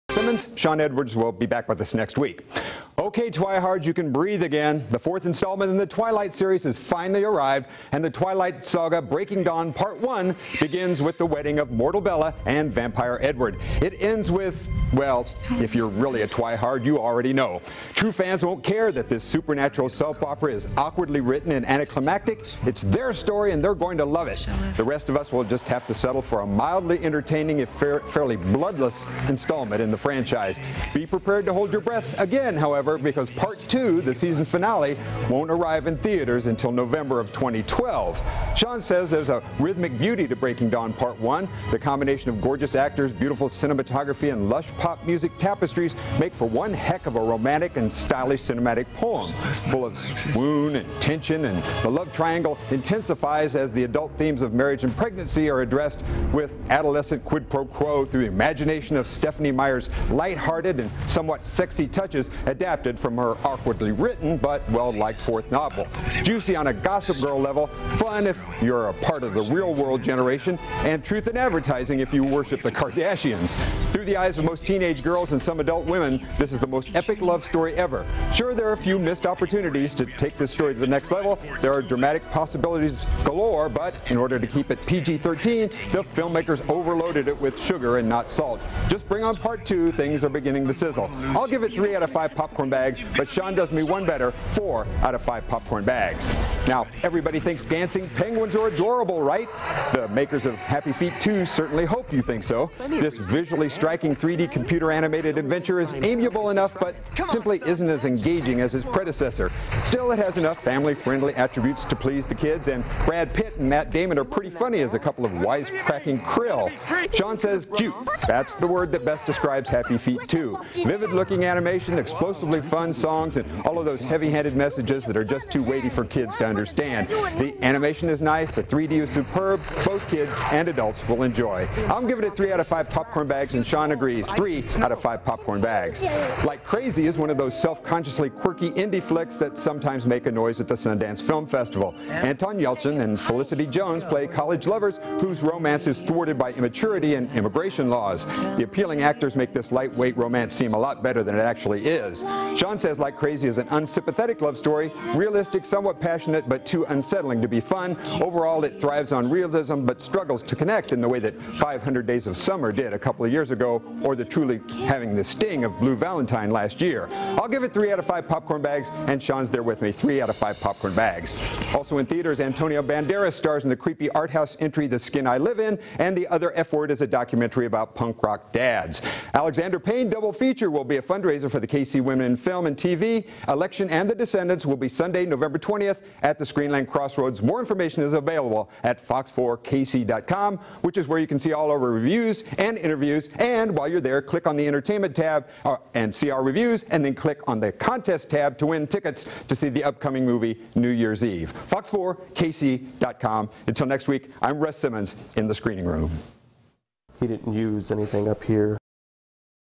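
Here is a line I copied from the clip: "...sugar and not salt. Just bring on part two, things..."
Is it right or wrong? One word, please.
right.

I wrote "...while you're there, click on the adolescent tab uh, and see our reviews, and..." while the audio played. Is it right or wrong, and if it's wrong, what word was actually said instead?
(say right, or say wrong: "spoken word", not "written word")
wrong: "entertainment", not "adolescent".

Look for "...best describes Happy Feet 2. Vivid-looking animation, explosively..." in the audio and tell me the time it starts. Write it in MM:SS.
01:59.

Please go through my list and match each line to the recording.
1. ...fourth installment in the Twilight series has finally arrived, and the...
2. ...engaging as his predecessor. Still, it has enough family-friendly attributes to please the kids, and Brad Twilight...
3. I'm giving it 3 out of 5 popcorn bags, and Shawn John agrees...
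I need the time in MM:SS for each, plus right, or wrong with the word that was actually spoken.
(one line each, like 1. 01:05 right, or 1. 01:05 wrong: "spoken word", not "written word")
1. 00:04 right
2. 01:48 wrong: "Pitt", not "Twilight"
3. 02:11 right.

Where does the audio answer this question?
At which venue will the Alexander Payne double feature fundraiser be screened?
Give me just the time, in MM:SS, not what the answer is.
03:06.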